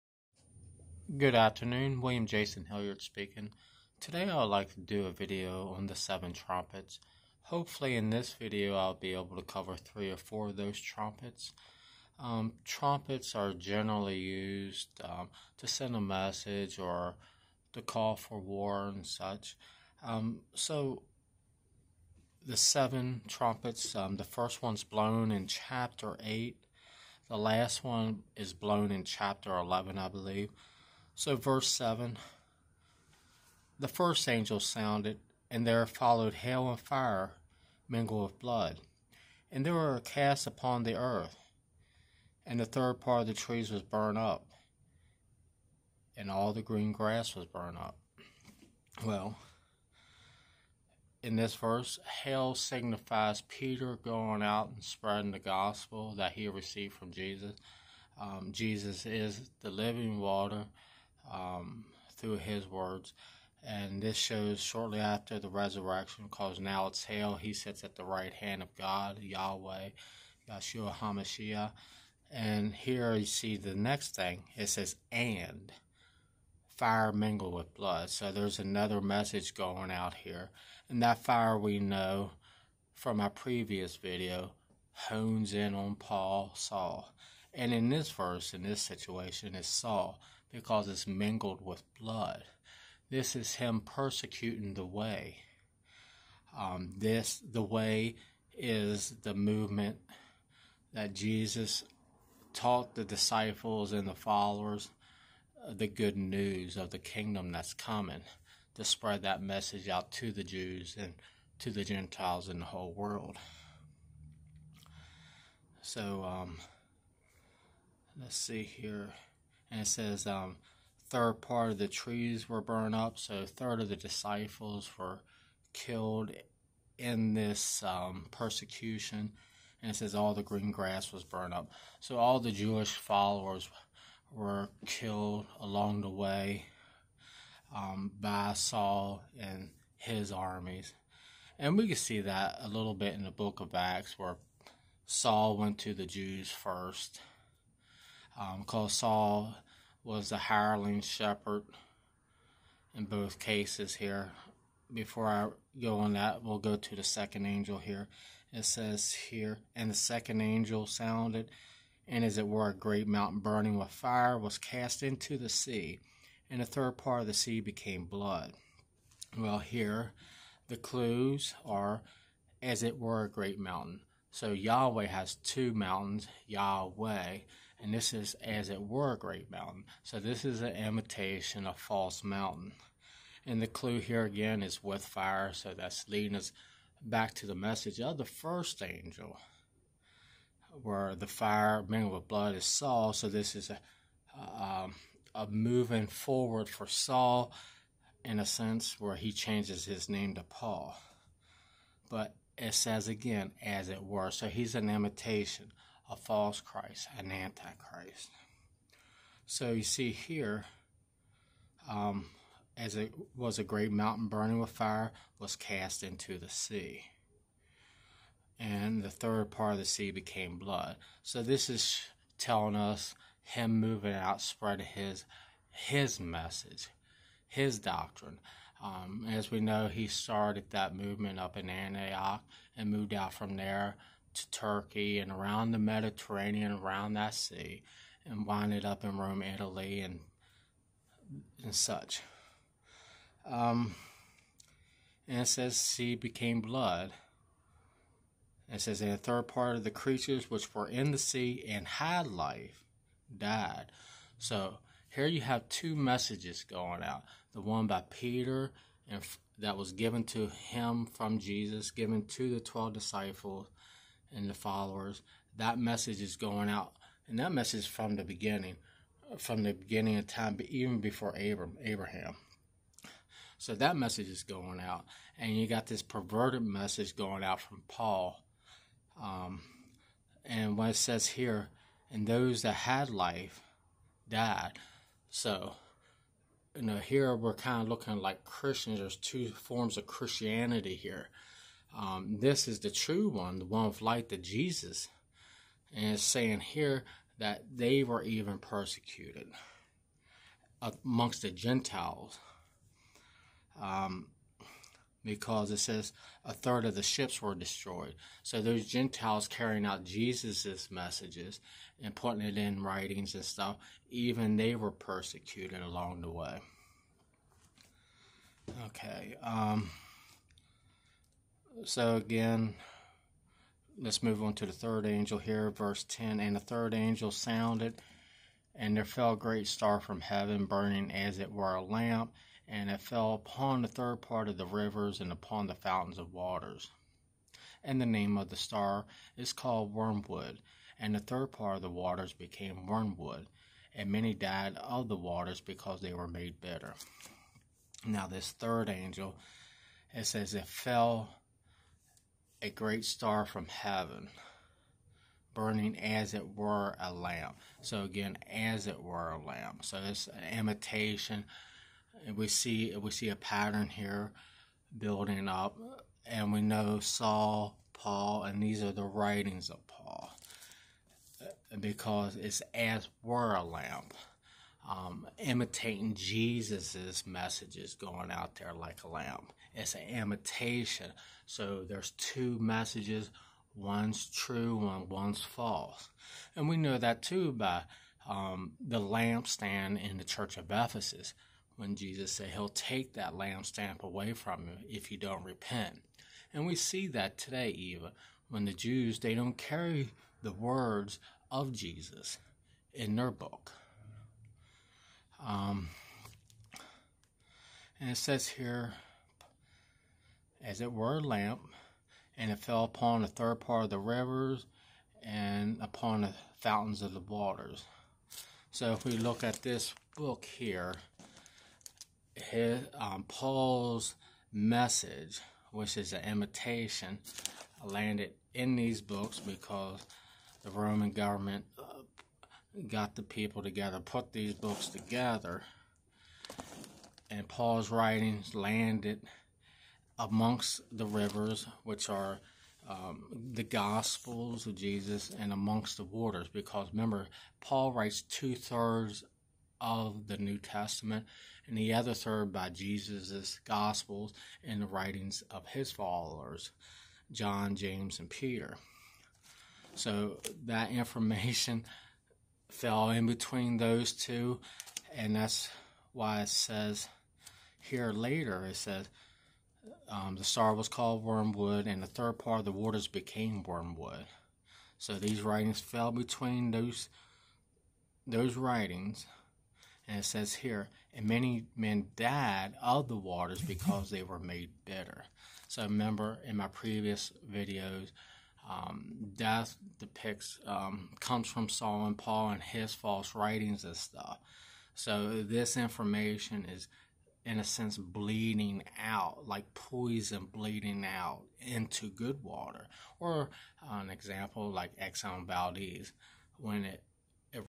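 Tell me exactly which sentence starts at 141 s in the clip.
And we can see that a little bit in the book of Acts where Saul went to the Jews first.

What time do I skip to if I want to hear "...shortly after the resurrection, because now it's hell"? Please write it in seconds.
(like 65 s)
64 s.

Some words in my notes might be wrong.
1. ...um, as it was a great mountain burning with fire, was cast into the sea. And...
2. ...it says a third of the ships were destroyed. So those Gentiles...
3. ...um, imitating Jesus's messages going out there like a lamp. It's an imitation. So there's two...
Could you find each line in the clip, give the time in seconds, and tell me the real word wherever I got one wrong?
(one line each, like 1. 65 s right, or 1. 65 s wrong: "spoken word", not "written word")
1. 211 s right
2. 305 s right
3. 374 s right.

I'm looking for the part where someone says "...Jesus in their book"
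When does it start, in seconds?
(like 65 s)
401 s.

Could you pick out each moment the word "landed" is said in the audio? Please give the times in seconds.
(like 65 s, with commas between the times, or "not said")
427 s, 438 s.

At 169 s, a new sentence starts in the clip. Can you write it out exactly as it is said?
Well, here the clues are as it were a great mountain.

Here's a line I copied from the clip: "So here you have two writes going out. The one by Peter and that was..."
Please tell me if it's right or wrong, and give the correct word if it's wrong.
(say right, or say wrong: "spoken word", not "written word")
wrong: "messages", not "writes".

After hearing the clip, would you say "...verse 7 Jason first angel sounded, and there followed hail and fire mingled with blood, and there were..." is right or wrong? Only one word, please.
wrong.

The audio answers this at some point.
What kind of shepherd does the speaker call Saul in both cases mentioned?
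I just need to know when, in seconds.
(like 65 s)
150 s.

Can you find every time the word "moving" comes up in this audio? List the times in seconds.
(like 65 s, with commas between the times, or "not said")
195 s, 223 s.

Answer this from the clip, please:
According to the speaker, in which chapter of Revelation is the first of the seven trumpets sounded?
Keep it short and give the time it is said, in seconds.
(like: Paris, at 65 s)
Chapter 8, at 25 s.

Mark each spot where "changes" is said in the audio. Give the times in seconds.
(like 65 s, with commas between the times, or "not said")
199 s.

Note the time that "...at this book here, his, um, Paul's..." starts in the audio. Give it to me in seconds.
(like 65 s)
419 s.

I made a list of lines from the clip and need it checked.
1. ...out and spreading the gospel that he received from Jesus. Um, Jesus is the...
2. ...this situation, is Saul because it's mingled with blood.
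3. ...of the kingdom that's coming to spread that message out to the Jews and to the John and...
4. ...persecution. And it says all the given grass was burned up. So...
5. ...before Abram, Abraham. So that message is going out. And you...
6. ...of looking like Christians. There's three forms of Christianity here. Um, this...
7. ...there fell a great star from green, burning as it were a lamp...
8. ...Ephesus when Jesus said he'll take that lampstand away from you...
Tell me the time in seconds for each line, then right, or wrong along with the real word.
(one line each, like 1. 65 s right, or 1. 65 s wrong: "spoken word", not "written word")
1. 54 s right
2. 88 s right
3. 106 s wrong: "Gentiles", not "John"
4. 128 s wrong: "green", not "given"
5. 270 s right
6. 287 s wrong: "two", not "three"
7. 328 s wrong: "heaven", not "green"
8. 390 s right.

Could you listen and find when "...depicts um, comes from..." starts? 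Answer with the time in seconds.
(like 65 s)
489 s.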